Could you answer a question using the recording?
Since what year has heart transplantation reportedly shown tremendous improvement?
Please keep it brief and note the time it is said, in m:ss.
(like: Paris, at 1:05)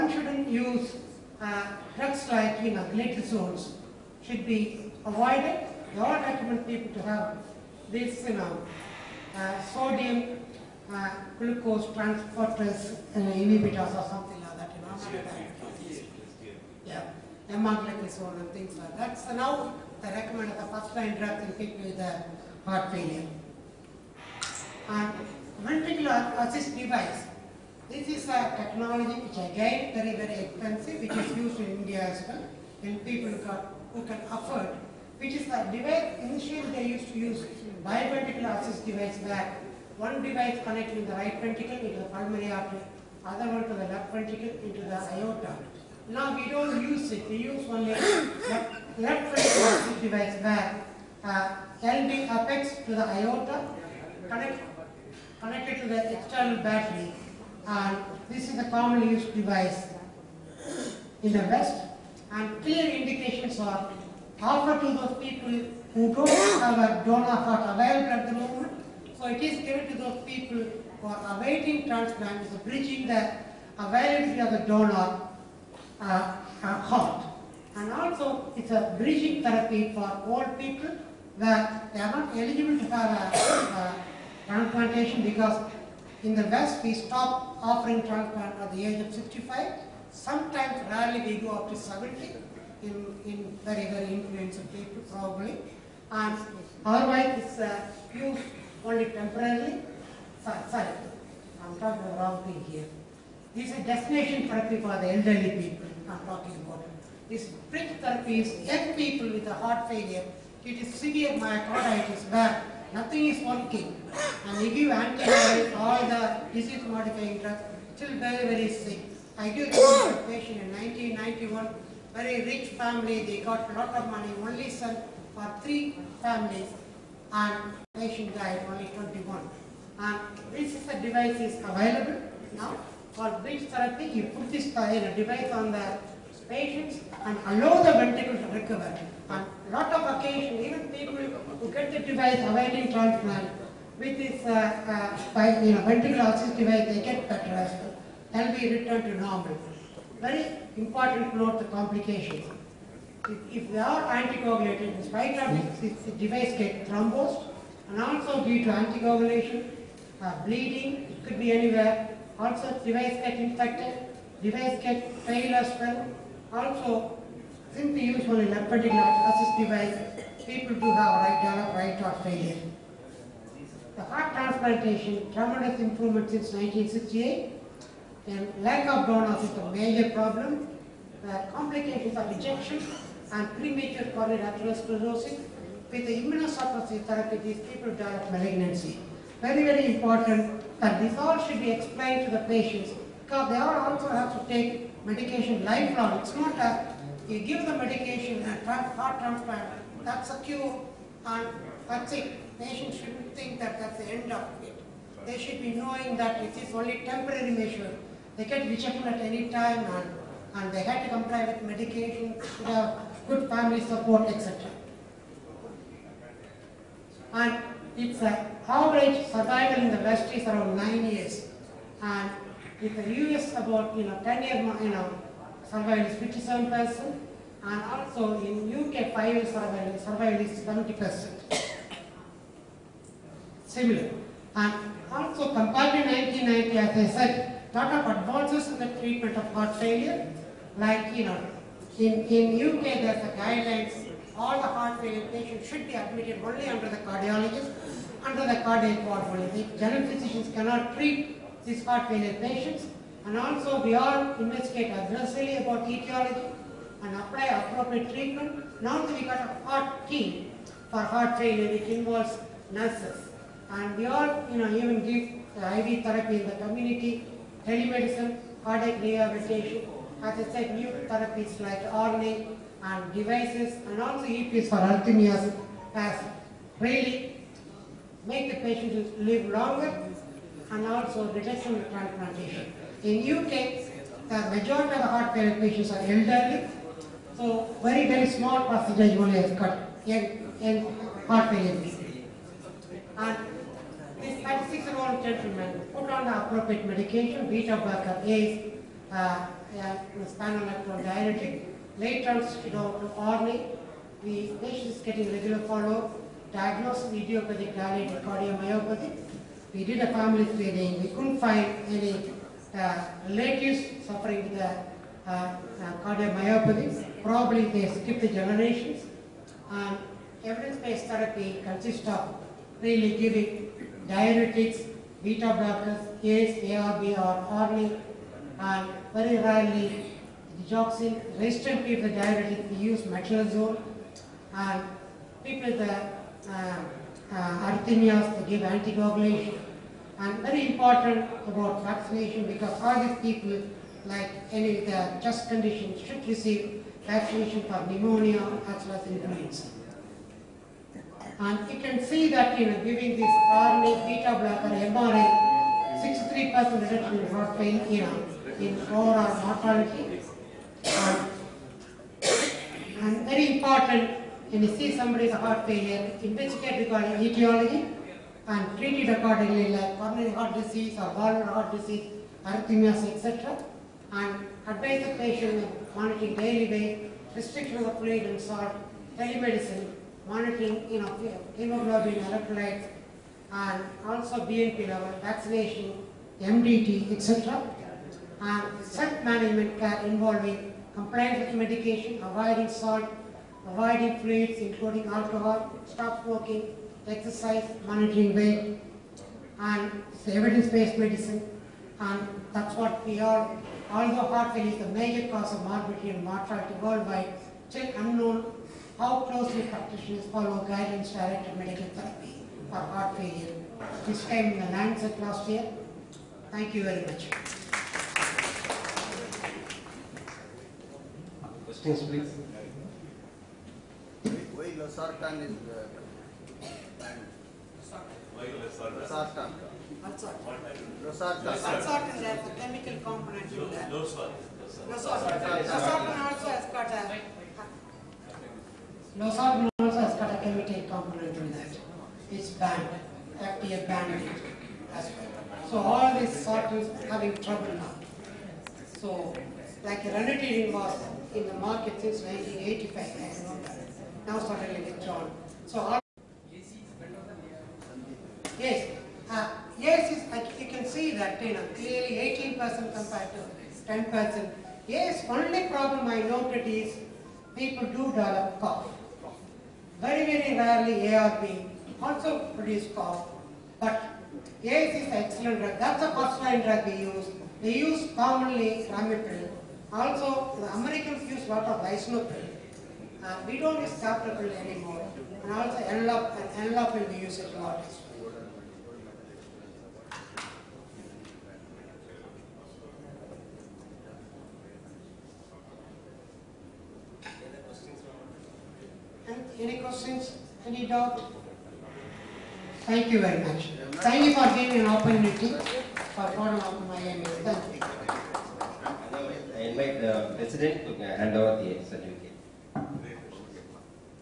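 1968, at 2:56.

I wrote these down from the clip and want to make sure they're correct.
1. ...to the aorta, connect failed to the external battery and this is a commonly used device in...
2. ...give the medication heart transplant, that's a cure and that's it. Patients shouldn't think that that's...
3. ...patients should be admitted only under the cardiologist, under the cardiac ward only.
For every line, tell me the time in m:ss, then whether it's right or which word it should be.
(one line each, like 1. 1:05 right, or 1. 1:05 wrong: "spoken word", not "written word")
1. 0:52 wrong: "connected", not "failed"
2. 3:17 right
3. 4:05 right.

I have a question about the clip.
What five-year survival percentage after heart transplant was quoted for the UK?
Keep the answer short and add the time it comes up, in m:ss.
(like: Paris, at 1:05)
70%, at 3:50.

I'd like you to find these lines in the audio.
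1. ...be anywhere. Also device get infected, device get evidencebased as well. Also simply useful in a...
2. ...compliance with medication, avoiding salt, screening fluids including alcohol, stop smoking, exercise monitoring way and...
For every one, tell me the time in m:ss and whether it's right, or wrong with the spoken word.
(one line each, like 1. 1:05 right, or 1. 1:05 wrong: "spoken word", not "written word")
1. 2:41 wrong: "failed", not "evidencebased"
2. 6:30 wrong: "avoiding", not "screening".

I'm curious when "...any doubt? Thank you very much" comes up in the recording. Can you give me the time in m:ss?
8:20.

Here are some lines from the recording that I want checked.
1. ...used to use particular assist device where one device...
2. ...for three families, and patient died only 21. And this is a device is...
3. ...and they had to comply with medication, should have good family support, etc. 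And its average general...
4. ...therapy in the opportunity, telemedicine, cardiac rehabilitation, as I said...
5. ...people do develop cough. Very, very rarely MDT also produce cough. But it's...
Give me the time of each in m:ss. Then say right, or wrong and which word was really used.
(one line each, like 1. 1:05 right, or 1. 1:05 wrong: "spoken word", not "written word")
1. 0:36 wrong: "biventricular", not "particular"
2. 2:05 right
3. 3:30 wrong: "survival", not "general"
4. 4:26 wrong: "community", not "opportunity"
5. 7:47 wrong: "ARB", not "MDT".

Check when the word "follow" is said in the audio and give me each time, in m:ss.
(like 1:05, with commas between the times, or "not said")
5:05, 6:50.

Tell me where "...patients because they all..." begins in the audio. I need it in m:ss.
3:12.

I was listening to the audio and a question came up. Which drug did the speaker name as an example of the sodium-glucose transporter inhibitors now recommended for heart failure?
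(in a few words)
Empagliflozin.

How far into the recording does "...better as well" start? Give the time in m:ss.
2:27.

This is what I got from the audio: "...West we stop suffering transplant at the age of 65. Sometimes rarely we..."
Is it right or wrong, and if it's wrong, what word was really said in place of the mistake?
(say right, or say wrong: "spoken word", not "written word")
wrong: "offering", not "suffering".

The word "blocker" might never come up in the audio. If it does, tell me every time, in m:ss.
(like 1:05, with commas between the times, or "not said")
4:57, 5:25, 5:54.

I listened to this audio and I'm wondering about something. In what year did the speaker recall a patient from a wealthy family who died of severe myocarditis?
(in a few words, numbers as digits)
1991.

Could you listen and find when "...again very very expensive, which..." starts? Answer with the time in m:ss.
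0:29.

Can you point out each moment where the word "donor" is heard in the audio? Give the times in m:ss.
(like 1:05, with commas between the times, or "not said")
1:07, 1:14, 2:59.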